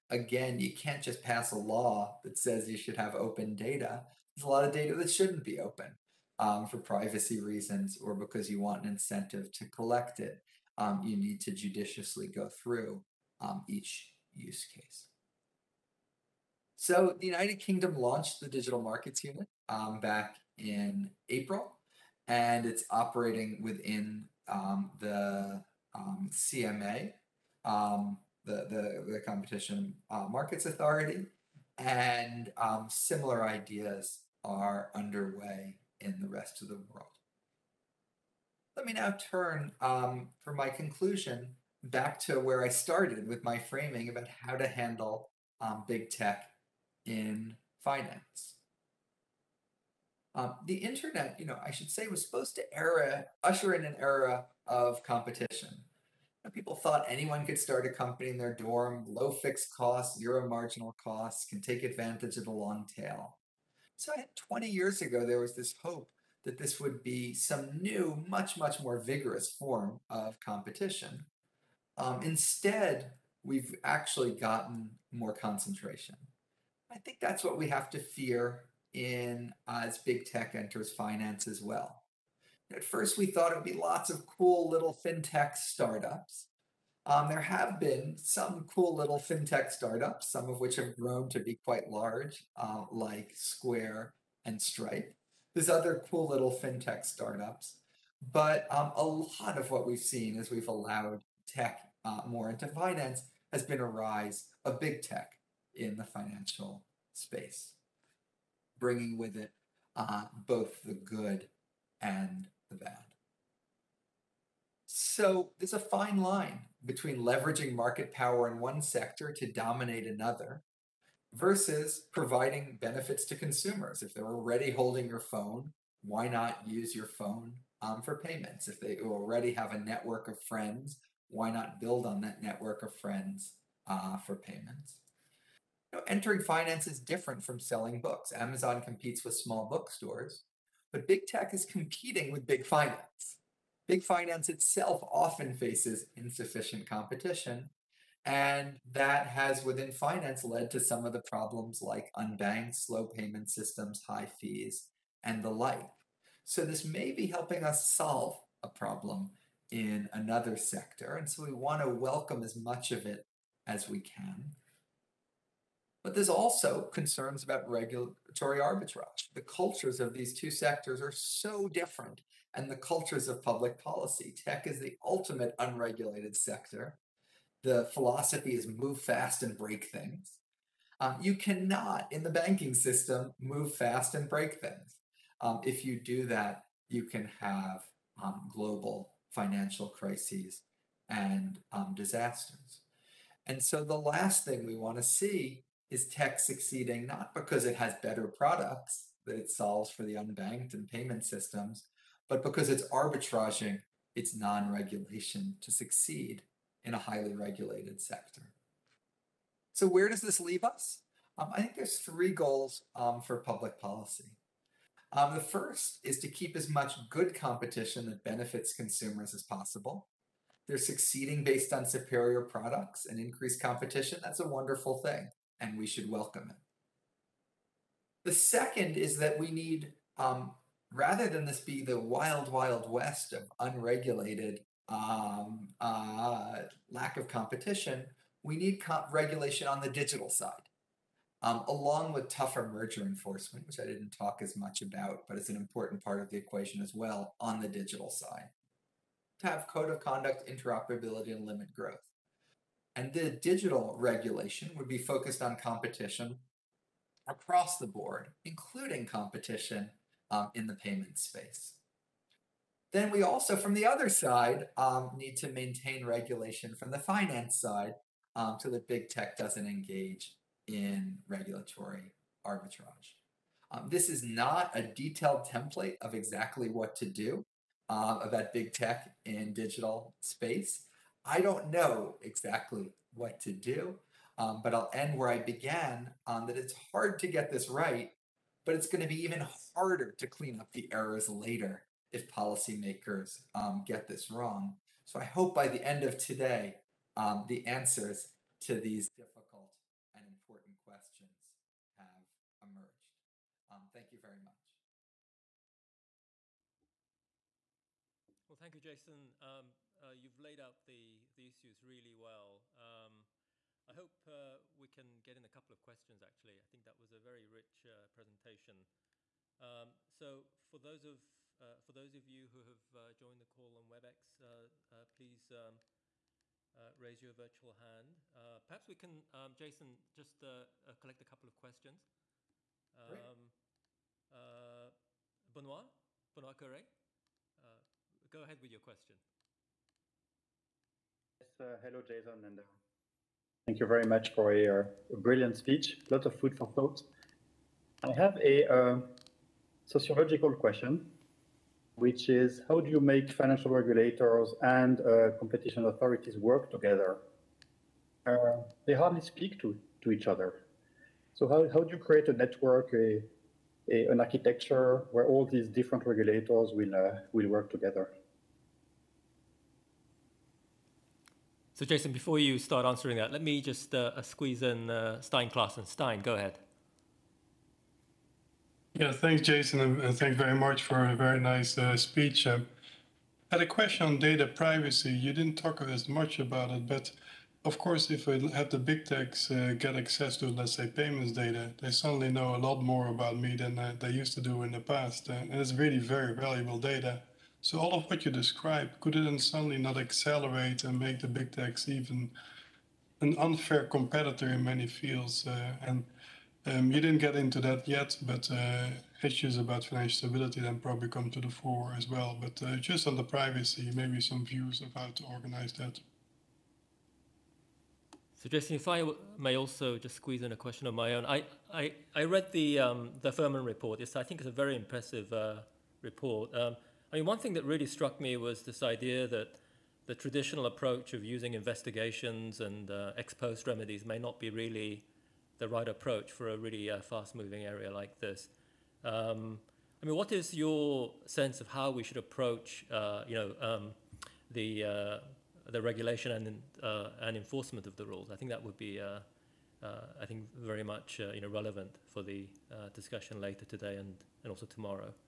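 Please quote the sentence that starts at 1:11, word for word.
Um, instead, we've actually gotten more concentration.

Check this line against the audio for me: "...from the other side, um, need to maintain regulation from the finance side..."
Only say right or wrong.
right.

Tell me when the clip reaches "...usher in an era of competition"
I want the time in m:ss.
0:53.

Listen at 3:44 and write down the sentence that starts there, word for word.
That's a wonderful thing and we should welcome it.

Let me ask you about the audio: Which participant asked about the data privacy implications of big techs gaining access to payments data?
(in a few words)
Stijn Claessens.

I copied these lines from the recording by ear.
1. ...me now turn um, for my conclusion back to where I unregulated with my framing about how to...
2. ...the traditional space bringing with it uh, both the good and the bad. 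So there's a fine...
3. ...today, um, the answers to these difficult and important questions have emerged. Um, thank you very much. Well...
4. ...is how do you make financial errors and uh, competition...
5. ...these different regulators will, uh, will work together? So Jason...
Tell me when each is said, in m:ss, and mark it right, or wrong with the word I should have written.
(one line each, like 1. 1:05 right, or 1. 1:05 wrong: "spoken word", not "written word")
1. 0:38 wrong: "started", not "unregulated"
2. 1:45 wrong: "financial", not "traditional"
3. 4:56 right
4. 5:52 wrong: "regulators", not "errors"
5. 6:05 right.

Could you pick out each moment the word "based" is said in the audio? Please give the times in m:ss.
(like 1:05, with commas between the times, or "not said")
3:41.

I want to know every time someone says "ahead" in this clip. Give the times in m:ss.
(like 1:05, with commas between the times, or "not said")
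5:38, 6:16.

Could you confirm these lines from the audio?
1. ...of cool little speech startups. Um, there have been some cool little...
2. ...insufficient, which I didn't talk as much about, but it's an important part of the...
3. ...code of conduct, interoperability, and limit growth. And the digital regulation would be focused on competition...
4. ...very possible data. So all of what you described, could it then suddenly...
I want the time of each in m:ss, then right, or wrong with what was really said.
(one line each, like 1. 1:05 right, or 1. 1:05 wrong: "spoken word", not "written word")
1. 1:24 wrong: "fintech", not "speech"
2. 4:03 wrong: "enforcement", not "insufficient"
3. 4:09 right
4. 6:35 wrong: "valuable", not "possible".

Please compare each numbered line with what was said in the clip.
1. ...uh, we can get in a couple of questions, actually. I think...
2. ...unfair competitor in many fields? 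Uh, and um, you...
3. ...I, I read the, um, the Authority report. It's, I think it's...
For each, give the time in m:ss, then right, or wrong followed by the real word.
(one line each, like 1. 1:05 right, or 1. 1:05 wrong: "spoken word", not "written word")
1. 5:14 right
2. 6:43 right
3. 7:01 wrong: "Furman", not "Authority".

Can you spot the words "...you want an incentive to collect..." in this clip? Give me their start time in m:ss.
0:08.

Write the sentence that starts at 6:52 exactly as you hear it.
But uh, just on the privacy, maybe some views of how to organize that.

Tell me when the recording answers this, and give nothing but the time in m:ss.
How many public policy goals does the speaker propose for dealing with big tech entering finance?
3:31.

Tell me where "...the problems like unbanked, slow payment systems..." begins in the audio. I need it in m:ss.
2:31.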